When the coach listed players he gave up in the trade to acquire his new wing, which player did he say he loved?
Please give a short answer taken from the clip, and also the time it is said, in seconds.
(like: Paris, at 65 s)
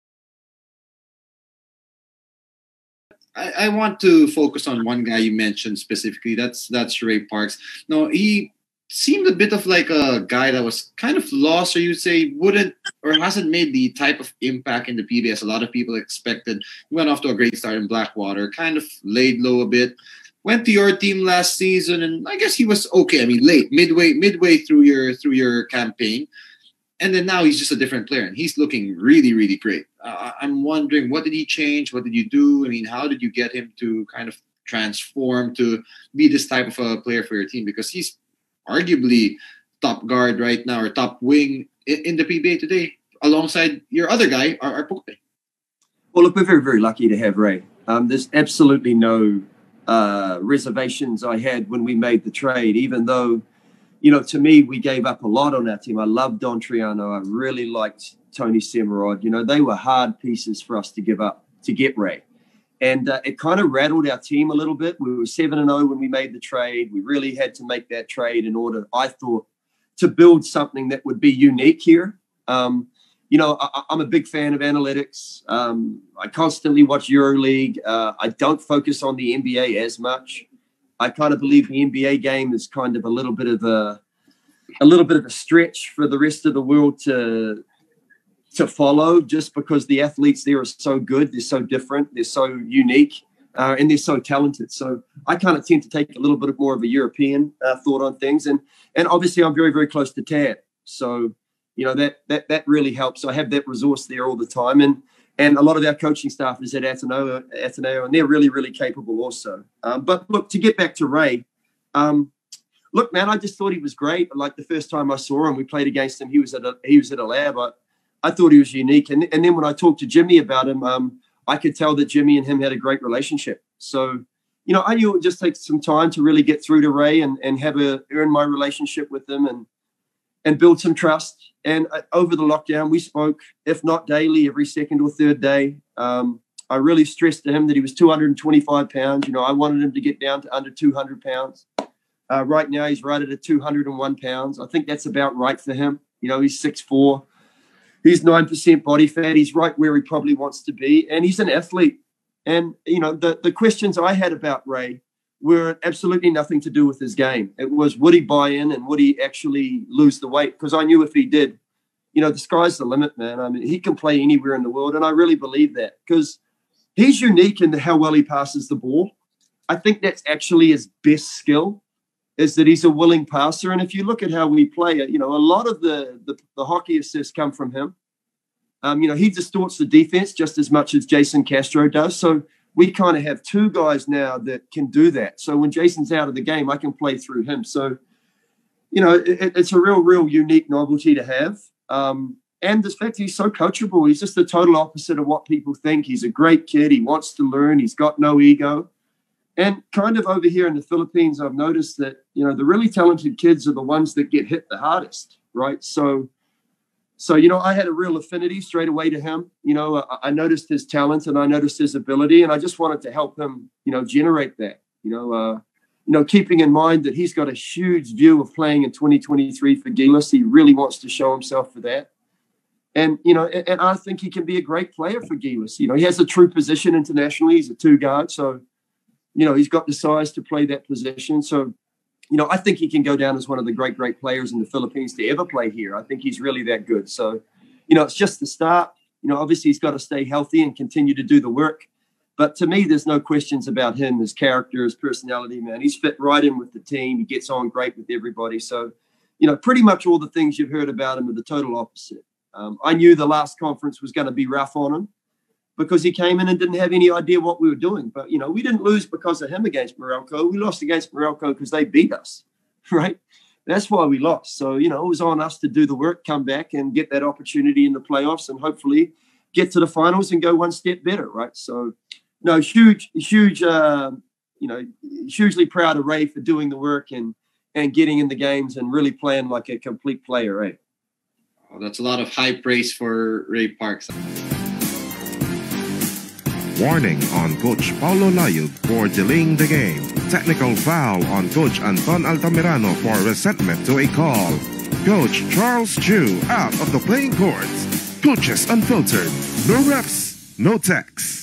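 Don Trollano, at 56 s.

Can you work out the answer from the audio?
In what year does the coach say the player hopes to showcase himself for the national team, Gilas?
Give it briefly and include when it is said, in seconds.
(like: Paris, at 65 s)
2023, at 218 s.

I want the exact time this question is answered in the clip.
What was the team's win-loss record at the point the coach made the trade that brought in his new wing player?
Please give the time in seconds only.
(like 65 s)
65 s.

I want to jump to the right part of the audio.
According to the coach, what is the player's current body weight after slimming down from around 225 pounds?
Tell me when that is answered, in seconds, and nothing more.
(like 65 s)
143 s.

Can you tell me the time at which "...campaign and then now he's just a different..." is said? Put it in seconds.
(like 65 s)
25 s.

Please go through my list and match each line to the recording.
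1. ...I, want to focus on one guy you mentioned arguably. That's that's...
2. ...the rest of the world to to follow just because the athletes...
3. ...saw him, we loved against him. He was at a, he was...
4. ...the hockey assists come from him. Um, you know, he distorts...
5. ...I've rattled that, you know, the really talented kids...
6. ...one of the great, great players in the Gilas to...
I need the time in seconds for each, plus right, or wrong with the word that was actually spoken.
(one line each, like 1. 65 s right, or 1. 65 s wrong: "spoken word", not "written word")
1. 3 s wrong: "specifically", not "arguably"
2. 86 s right
3. 115 s wrong: "played", not "loved"
4. 176 s right
5. 201 s wrong: "noticed", not "rattled"
6. 233 s wrong: "Philippines", not "Gilas".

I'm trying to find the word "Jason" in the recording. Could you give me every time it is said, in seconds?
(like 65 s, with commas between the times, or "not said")
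181 s, 185 s.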